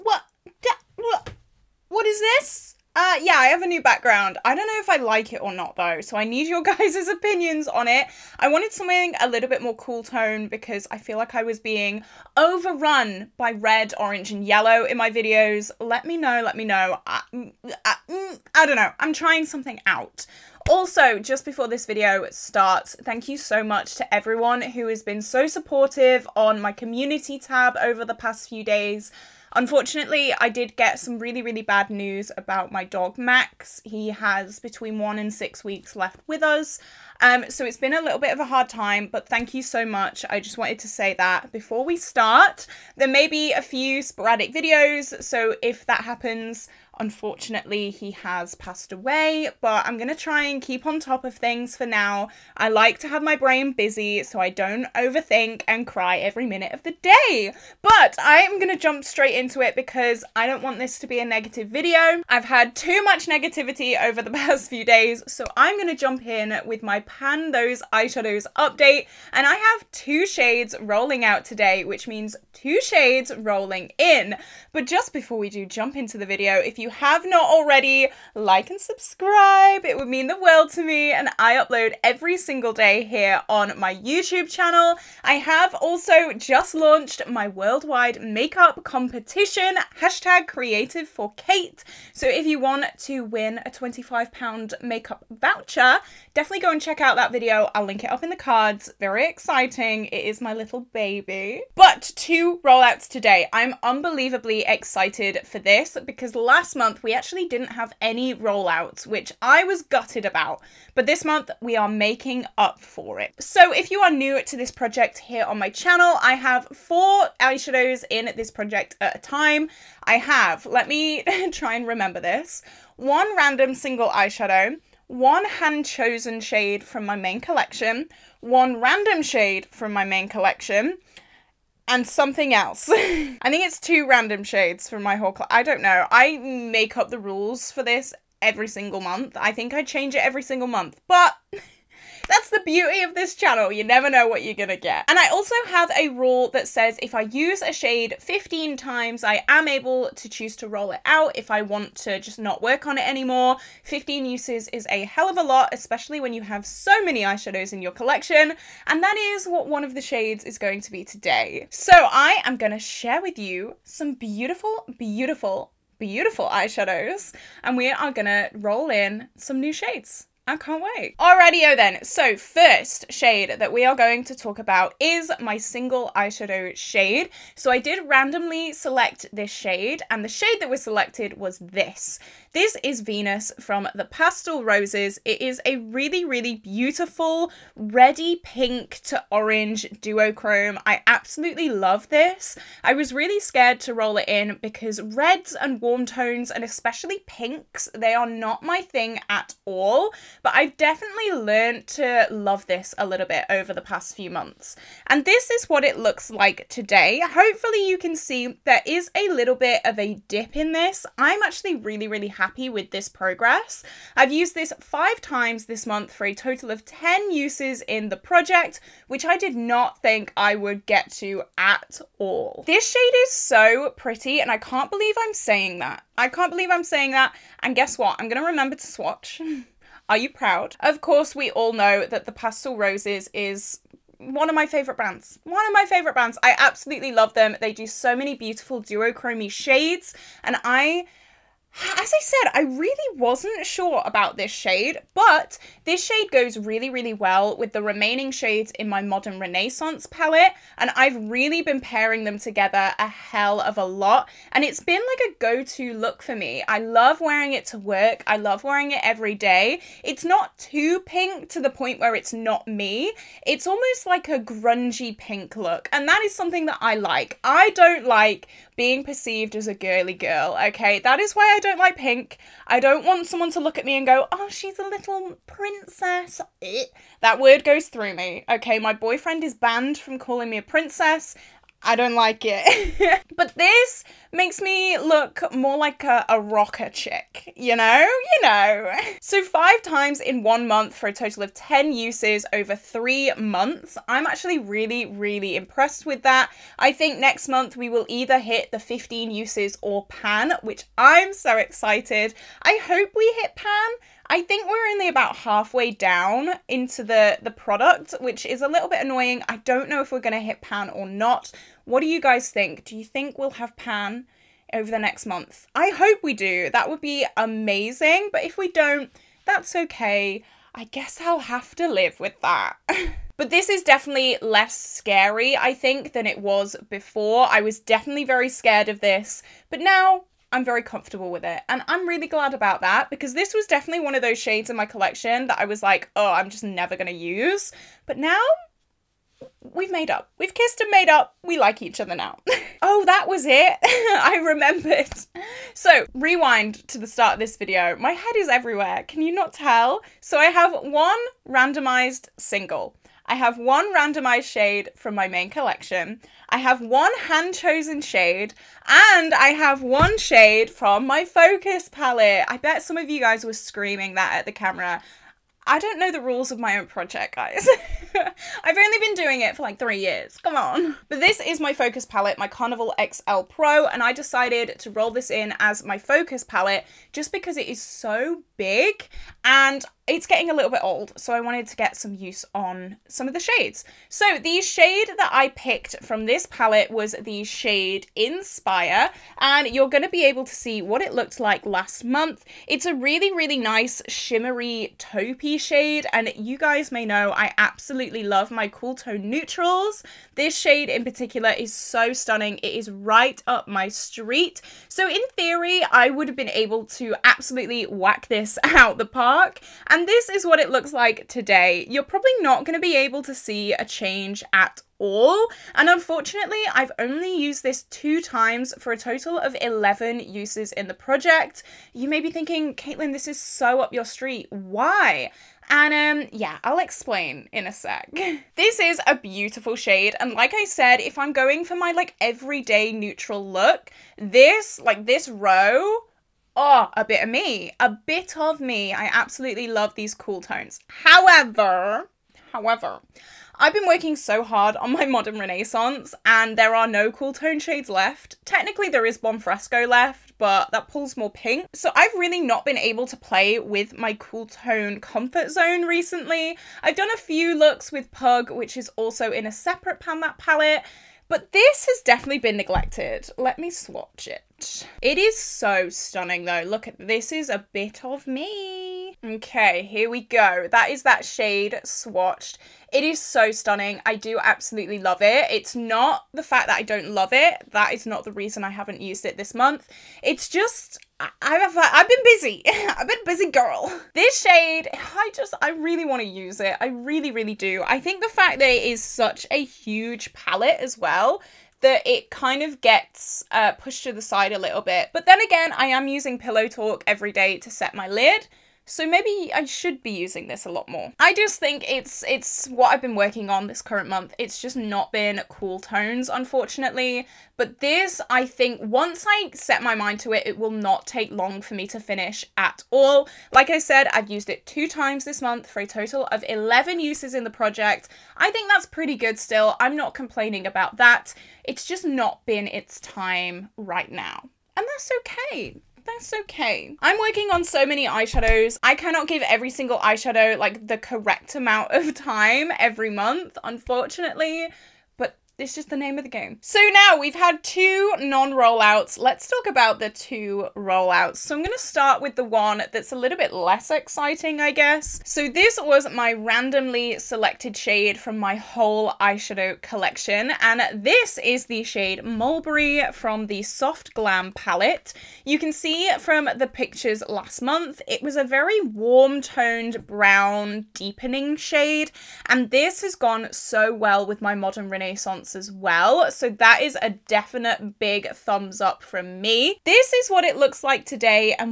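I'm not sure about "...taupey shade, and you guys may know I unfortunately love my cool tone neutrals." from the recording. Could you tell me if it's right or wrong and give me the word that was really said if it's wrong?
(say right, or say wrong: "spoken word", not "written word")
wrong: "absolutely", not "unfortunately".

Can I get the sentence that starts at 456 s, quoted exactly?
I've done a few looks with Pug, which is also in a separate Pan That palette, but this has definitely been neglected.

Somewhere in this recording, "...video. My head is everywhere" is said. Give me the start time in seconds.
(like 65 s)
347 s.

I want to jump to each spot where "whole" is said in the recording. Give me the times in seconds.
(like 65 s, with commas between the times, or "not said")
135 s, 548 s.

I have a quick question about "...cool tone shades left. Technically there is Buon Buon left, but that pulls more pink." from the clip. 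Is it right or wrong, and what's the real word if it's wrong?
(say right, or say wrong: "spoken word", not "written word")
wrong: "Fresco", not "Buon".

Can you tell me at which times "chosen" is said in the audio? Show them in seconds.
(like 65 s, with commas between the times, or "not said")
125 s, 357 s.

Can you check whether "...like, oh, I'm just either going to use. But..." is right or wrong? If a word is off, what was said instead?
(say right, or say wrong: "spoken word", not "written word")
wrong: "never", not "either".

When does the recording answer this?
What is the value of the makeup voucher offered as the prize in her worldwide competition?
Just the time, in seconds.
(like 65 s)
93 s.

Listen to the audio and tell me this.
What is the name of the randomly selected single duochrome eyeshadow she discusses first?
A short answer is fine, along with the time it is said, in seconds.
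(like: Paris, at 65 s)
Venus, at 183 s.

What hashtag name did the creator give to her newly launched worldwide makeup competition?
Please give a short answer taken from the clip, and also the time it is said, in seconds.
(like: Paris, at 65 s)
creative for Kate, at 90 s.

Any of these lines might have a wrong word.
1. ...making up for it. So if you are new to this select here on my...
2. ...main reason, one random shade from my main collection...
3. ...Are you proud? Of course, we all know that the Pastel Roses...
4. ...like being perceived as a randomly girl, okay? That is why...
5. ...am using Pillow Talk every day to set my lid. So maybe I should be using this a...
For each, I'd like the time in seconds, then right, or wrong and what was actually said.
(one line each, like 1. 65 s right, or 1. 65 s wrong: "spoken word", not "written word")
1. 111 s wrong: "project", not "select"
2. 127 s wrong: "collection", not "reason"
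3. 230 s right
4. 268 s wrong: "girly", not "randomly"
5. 495 s right.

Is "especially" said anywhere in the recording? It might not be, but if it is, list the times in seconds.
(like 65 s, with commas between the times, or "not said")
155 s, 196 s.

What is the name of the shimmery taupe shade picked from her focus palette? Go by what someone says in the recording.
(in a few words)
Inspire.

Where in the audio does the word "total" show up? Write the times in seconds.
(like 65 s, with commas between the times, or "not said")
216 s, 291 s, 418 s, 515 s.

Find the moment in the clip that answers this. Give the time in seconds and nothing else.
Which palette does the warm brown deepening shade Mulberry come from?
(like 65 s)
553 s.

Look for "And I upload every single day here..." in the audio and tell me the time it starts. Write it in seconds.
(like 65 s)
81 s.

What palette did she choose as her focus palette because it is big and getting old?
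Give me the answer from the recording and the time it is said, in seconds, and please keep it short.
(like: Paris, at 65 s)
Carnival XL Pro, at 372 s.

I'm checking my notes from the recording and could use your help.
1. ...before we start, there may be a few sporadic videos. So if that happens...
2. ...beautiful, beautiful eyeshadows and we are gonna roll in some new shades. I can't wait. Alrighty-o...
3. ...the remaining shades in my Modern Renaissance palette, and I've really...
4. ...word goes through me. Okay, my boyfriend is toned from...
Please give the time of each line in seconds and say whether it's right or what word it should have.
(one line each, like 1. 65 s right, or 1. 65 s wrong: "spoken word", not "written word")
1. 41 s right
2. 164 s right
3. 247 s right
4. 277 s wrong: "banned", not "toned".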